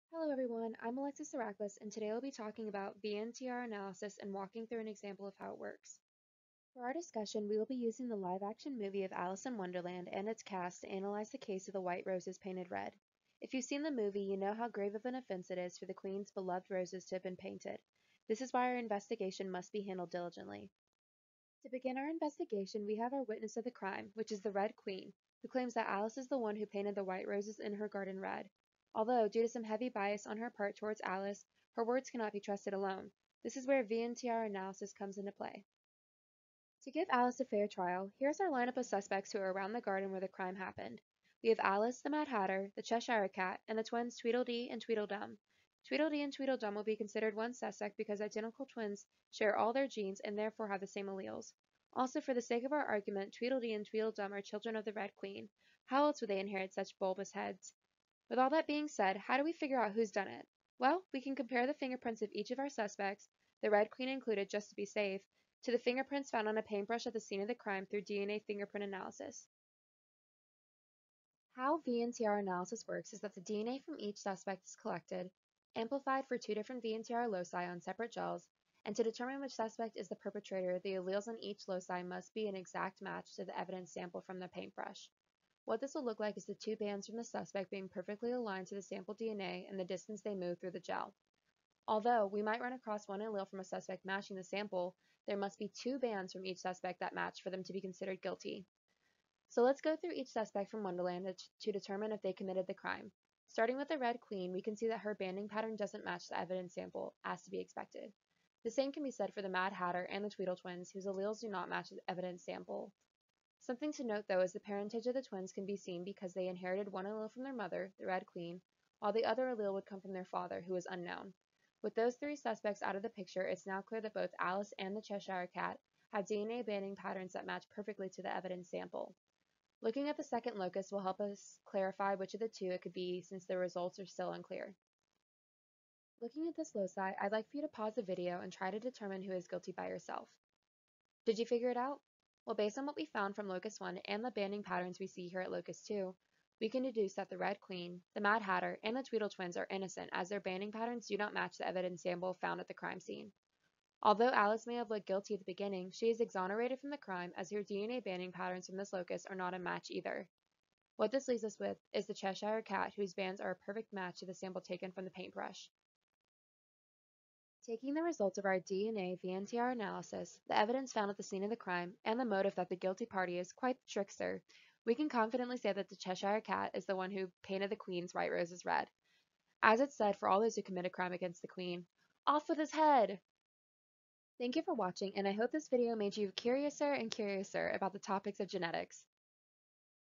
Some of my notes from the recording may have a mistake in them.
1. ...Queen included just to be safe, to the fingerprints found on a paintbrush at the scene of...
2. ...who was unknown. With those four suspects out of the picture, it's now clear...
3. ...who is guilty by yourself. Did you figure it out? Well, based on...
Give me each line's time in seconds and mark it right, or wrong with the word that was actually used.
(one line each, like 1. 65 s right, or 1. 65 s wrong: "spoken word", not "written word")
1. 63 s right
2. 120 s wrong: "three", not "four"
3. 139 s right.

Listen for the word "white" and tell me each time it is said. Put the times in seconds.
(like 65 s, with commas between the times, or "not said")
11 s, 27 s, 178 s.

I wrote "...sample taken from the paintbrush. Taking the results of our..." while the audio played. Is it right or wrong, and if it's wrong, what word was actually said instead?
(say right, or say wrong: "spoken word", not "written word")
right.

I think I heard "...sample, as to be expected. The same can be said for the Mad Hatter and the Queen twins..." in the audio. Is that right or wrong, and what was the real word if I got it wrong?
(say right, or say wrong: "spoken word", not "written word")
wrong: "Tweedle", not "Queen".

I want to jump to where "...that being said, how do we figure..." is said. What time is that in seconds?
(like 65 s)
58 s.